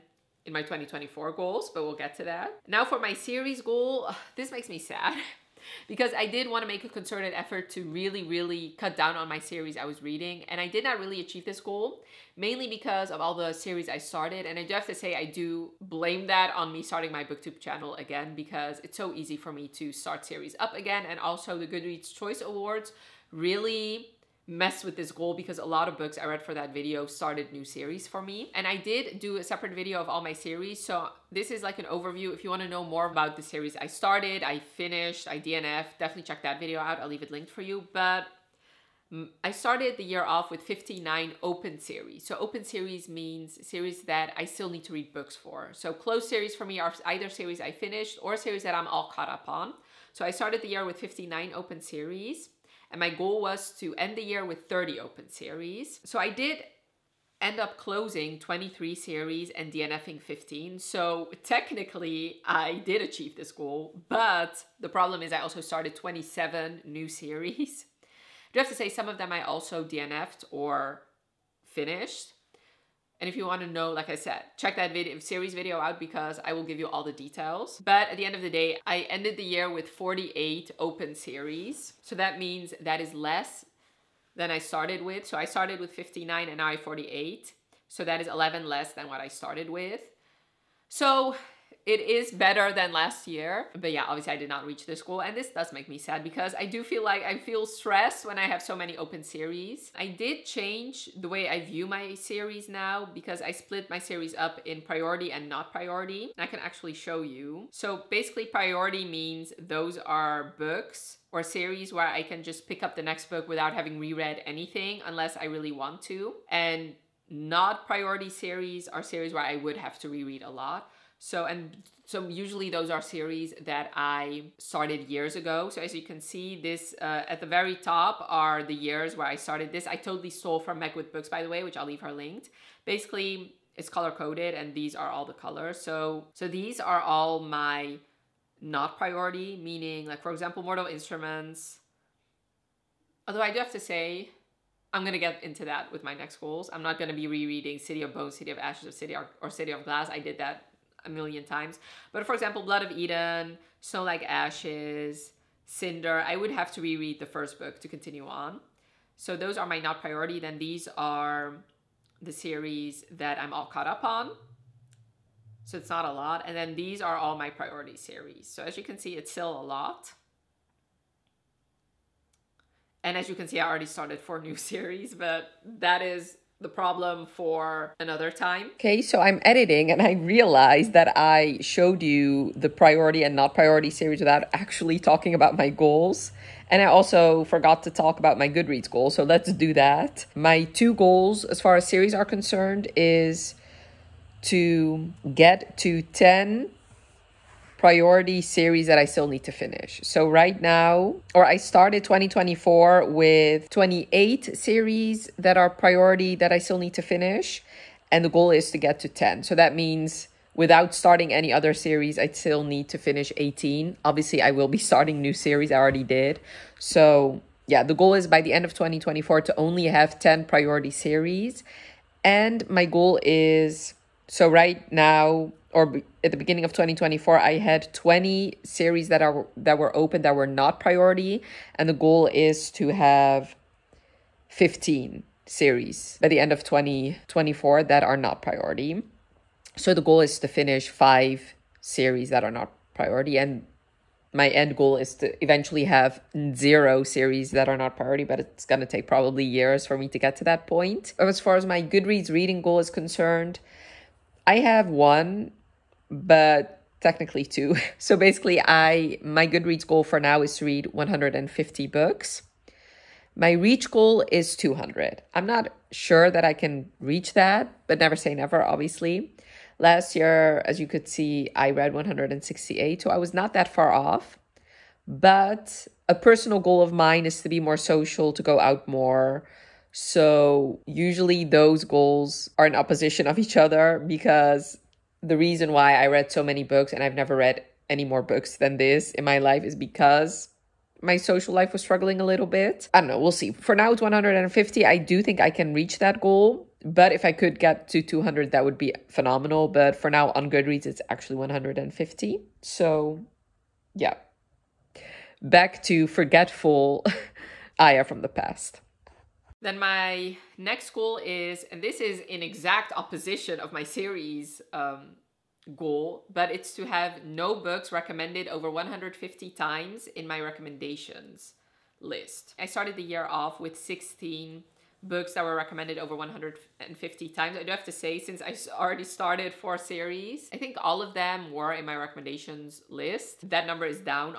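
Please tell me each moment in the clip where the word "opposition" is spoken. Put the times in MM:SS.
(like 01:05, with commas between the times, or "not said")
04:42, 05:12.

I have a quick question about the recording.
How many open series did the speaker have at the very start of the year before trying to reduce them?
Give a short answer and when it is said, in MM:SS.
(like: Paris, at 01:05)
59, at 00:50.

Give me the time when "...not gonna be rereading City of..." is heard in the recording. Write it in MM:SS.
02:26.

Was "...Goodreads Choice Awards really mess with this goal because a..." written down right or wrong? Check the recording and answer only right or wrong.
right.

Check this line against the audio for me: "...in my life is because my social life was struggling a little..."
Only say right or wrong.
right.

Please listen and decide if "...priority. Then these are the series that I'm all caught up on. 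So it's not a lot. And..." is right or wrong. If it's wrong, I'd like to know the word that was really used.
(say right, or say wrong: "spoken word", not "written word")
right.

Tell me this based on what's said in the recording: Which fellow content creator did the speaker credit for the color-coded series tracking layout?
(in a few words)
Meg with Books.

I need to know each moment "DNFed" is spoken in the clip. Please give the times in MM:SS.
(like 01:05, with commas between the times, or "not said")
01:09.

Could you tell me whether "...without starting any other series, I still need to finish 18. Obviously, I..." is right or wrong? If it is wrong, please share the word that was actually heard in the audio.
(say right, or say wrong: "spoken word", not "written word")
right.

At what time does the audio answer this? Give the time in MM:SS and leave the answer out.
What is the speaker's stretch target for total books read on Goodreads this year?
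04:23.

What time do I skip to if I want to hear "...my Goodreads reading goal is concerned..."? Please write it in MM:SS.
04:11.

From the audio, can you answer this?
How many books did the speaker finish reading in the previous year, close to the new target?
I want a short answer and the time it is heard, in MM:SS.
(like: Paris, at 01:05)
168, at 04:31.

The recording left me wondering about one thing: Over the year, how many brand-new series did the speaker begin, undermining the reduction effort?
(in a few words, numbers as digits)
27.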